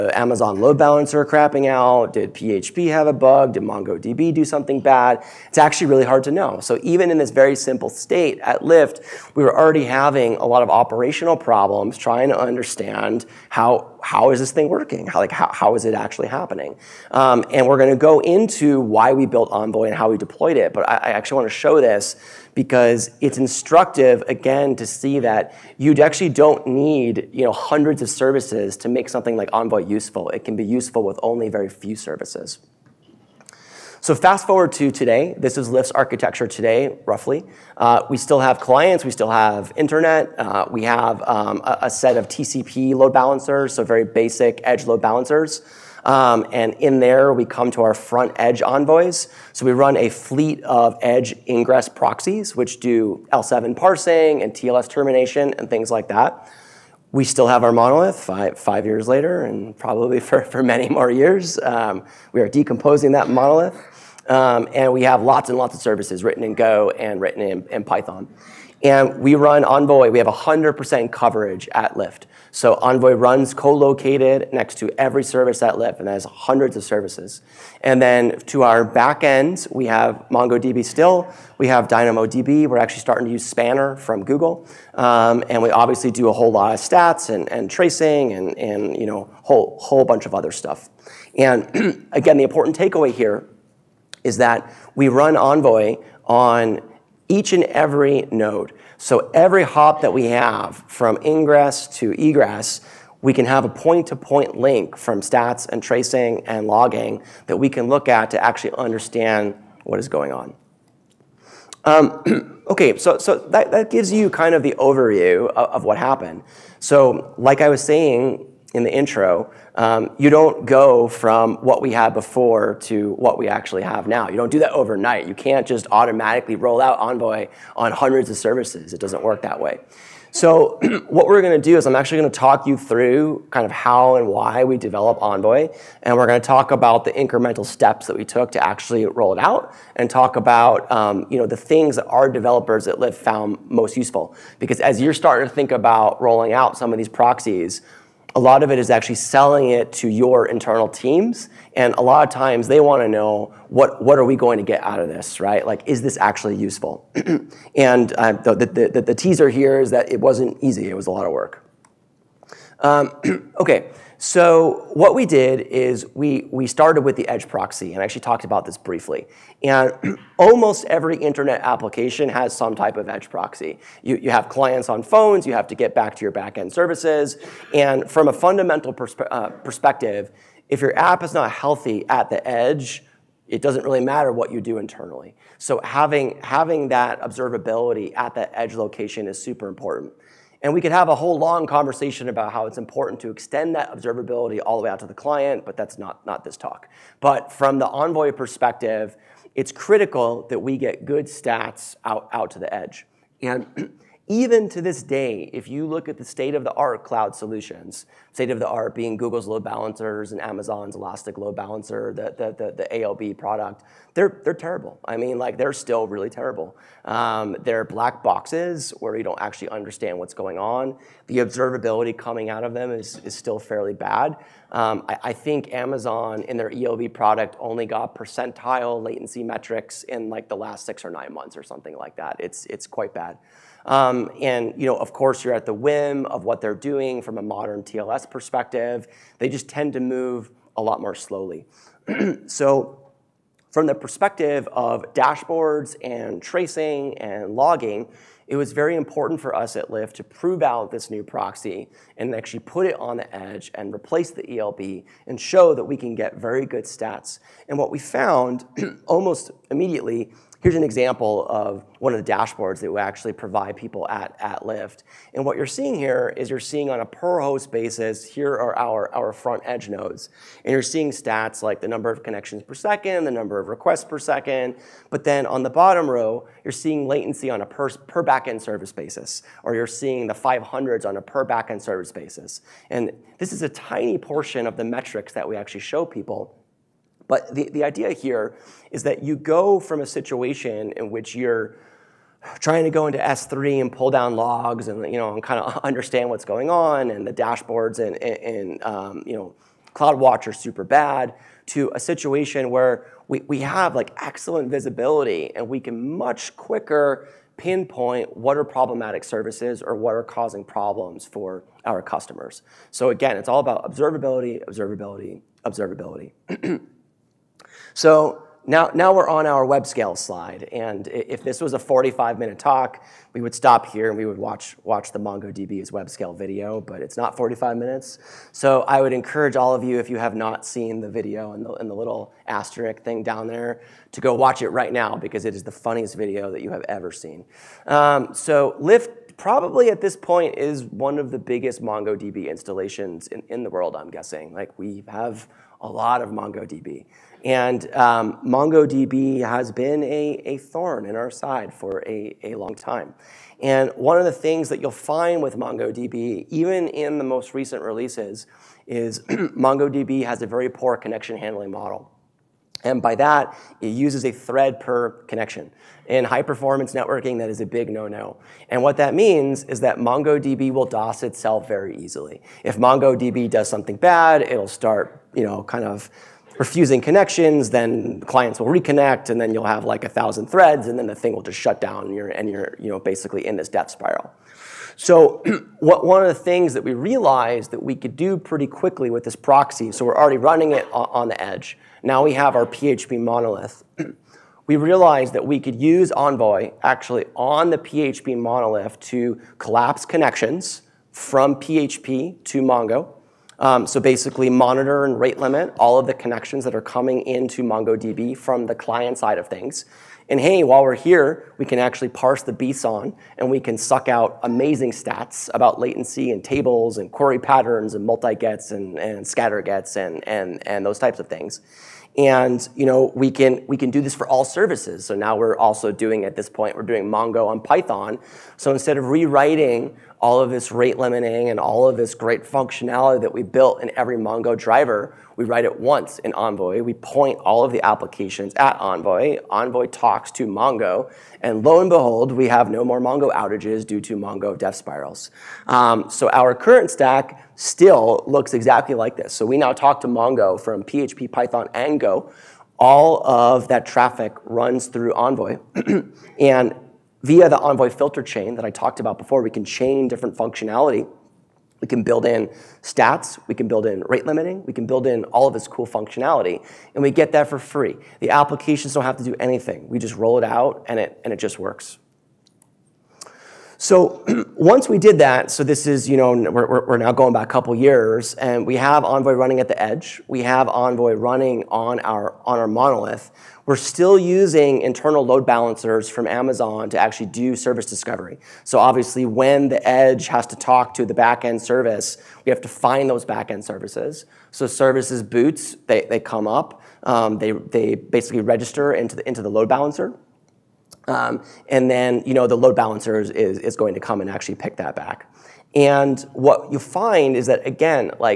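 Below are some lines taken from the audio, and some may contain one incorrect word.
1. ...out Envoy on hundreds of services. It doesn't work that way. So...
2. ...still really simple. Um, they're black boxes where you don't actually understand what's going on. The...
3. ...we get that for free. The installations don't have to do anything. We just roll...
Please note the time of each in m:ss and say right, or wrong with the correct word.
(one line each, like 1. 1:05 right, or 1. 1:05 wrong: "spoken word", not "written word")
1. 2:06 right
2. 3:35 wrong: "terrible", not "simple"
3. 7:47 wrong: "applications", not "installations".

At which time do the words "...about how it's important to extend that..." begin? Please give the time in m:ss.
3:12.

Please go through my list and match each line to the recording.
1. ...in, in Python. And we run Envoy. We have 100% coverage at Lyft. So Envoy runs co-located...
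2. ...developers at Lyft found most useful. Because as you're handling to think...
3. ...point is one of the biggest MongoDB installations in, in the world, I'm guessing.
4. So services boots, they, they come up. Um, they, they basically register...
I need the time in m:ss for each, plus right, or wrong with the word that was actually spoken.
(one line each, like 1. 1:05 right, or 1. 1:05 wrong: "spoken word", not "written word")
1. 1:07 right
2. 2:22 wrong: "starting", not "handling"
3. 5:40 right
4. 8:14 right.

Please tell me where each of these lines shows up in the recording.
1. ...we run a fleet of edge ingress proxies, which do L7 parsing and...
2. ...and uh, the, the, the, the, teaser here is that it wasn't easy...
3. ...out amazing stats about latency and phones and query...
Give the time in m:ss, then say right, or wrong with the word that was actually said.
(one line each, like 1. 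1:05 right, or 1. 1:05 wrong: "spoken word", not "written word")
1. 0:49 right
2. 2:37 right
3. 6:54 wrong: "tables", not "phones".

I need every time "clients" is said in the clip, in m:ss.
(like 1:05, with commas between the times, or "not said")
0:38, 2:54, 3:15, 6:18, 6:48.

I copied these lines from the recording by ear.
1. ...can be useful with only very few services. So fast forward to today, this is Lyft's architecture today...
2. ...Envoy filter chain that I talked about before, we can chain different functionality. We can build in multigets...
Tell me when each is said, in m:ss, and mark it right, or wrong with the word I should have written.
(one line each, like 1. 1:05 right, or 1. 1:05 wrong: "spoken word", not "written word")
1. 0:30 right
2. 7:37 wrong: "stats", not "multigets".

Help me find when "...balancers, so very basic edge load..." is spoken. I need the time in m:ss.
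0:43.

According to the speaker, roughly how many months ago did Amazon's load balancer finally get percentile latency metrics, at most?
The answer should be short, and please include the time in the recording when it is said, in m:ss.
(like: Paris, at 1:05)
9, at 3:51.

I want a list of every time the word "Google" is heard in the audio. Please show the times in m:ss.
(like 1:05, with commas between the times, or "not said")
1:24, 3:29.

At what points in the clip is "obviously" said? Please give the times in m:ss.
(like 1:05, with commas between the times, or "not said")
1:25, 8:08.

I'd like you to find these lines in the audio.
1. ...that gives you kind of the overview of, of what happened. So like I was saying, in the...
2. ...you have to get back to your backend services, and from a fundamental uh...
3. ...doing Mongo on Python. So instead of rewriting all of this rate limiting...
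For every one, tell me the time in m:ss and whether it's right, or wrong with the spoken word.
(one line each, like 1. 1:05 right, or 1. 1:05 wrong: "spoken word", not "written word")
1. 1:53 right
2. 2:55 right
3. 7:06 right.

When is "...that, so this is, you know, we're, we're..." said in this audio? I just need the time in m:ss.
7:55.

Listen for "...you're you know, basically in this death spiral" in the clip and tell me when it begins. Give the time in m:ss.
6:22.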